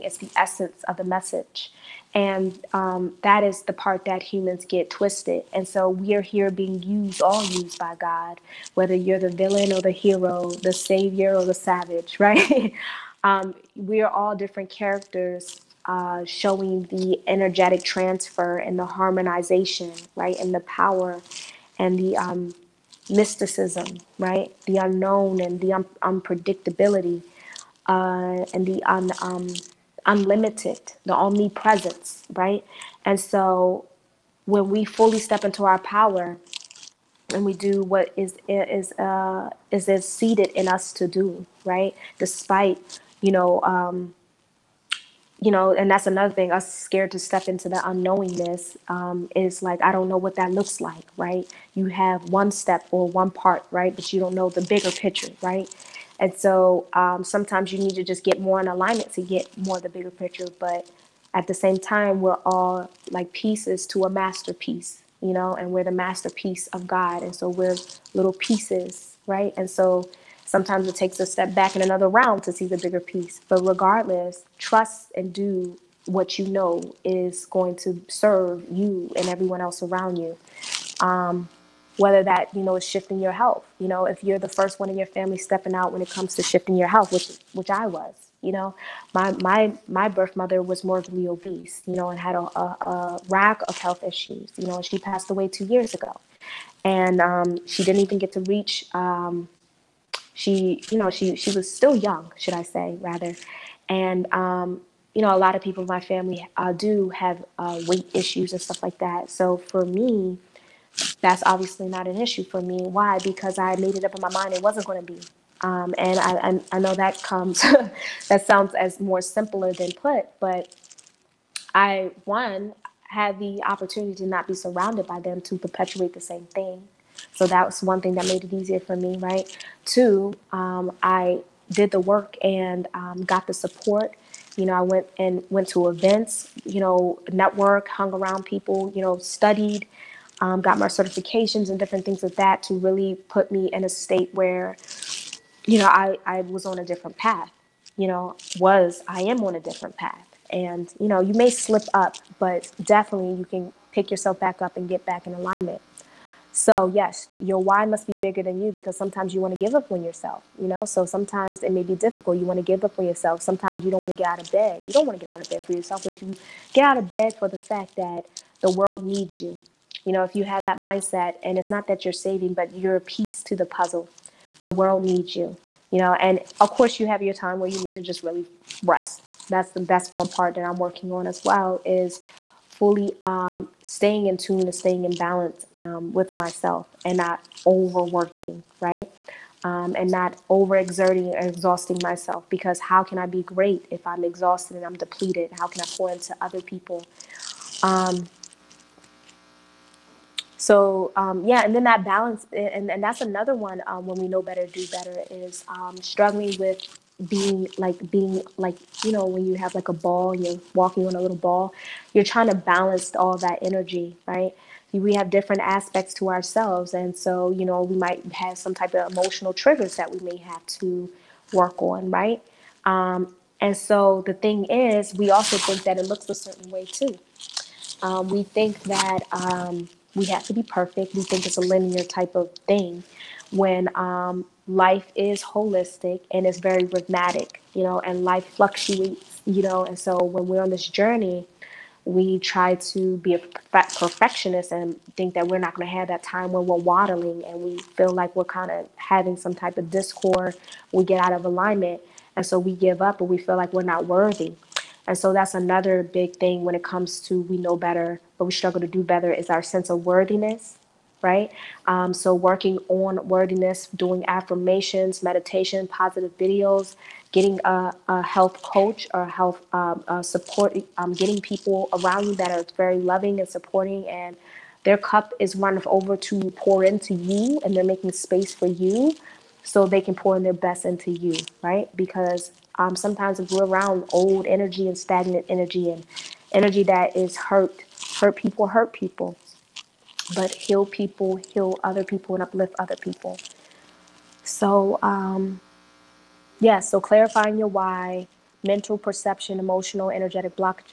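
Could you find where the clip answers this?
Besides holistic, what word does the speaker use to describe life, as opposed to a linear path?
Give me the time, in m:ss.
3:56.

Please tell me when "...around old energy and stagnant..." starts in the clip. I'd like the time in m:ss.
4:43.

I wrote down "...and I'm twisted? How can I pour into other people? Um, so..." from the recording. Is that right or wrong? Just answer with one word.
wrong.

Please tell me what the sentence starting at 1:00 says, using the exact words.
But at the same time, we're all like pieces to a masterpiece, you know, and we're the masterpiece of God.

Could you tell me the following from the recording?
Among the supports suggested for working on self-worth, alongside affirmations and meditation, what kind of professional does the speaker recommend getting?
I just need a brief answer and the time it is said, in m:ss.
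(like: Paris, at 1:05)
health coach, at 4:28.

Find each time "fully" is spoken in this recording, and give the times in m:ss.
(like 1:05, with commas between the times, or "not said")
0:34, 3:02.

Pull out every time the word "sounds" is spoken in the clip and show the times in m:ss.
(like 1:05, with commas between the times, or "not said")
1:58.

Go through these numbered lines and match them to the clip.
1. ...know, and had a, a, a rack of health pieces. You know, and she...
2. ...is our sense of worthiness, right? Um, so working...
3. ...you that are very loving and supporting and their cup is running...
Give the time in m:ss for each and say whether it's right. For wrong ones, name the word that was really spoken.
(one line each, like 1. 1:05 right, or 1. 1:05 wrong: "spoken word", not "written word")
1. 1:31 wrong: "issues", not "pieces"
2. 4:19 right
3. 4:32 right.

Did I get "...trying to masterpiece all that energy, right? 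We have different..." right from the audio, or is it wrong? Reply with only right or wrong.
wrong.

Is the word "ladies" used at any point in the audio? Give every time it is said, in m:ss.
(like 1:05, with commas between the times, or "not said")
not said.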